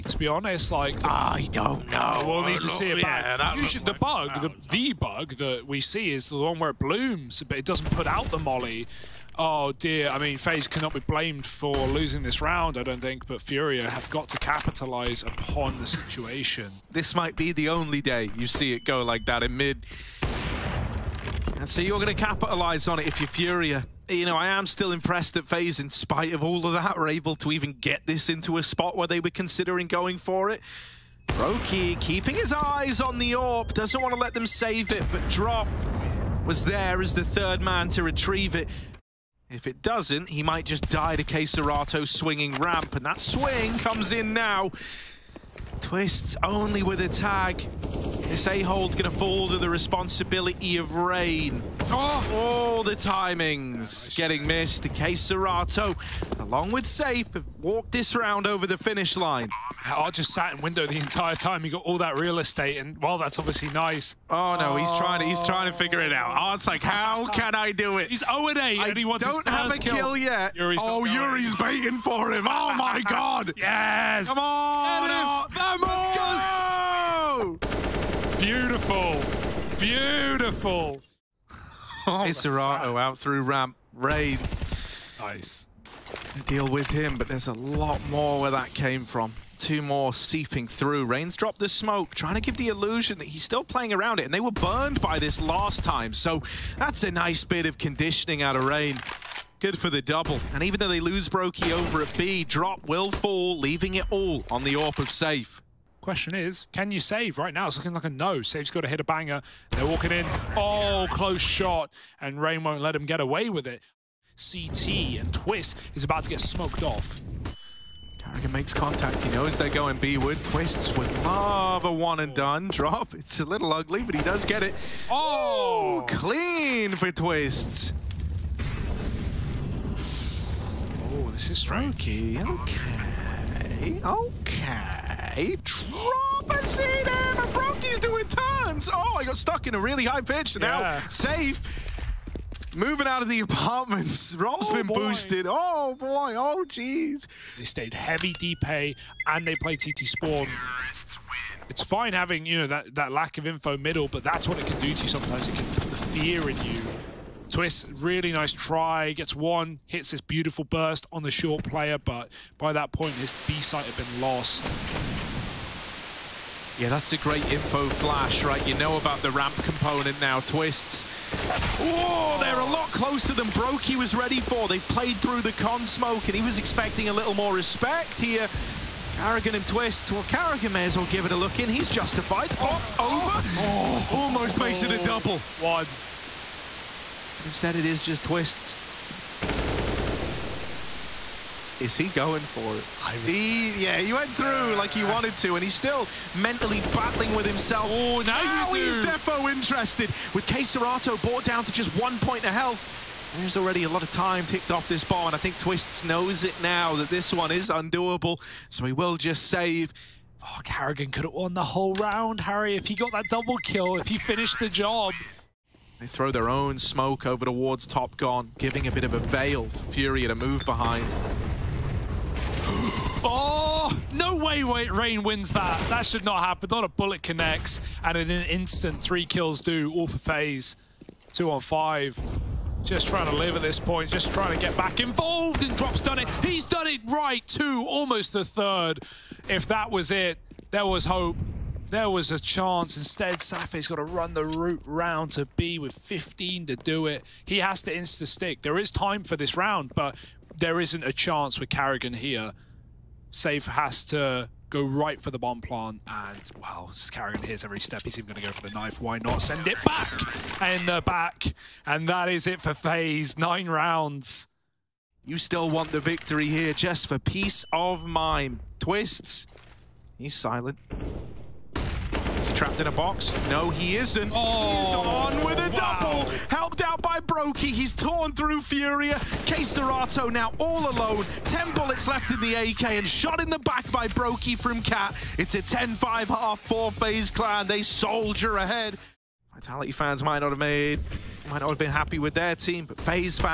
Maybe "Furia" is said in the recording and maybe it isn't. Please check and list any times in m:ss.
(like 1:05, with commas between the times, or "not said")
0:13, 0:23, 4:38.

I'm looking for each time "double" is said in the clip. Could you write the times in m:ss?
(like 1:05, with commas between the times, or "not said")
1:40, 3:05, 3:33, 4:35.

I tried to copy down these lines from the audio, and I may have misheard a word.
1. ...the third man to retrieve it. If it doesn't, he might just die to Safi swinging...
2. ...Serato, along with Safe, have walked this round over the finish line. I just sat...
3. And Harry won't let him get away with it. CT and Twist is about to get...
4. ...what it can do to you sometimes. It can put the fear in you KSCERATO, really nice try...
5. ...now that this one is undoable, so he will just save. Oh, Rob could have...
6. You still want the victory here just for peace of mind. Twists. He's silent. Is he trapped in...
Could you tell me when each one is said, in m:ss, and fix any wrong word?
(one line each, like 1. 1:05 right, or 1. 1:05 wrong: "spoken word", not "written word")
1. 0:37 wrong: "KSCERATO", not "Safi"
2. 0:55 right
3. 1:52 wrong: "Rain", not "Harry"
4. 2:34 wrong: "Twist", not "KSCERATO"
5. 3:26 wrong: "Karrigan", not "Rob"
6. 4:25 right.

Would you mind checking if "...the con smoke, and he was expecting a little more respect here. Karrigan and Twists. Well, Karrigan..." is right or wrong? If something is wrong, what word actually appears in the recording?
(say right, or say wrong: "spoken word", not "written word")
right.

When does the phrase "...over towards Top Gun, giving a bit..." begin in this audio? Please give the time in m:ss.
3:37.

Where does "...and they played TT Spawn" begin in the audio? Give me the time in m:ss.
2:29.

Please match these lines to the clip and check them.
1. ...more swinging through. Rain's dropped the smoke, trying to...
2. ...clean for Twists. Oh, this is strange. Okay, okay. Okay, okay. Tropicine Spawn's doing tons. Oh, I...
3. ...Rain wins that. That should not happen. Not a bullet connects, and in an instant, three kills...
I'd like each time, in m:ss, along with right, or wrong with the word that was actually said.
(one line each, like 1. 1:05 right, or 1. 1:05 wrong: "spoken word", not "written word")
1. 1:29 wrong: "seeping", not "swinging"
2. 2:06 wrong: "Broky", not "Spawn"
3. 3:44 right.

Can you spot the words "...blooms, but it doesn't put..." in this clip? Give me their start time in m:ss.
0:06.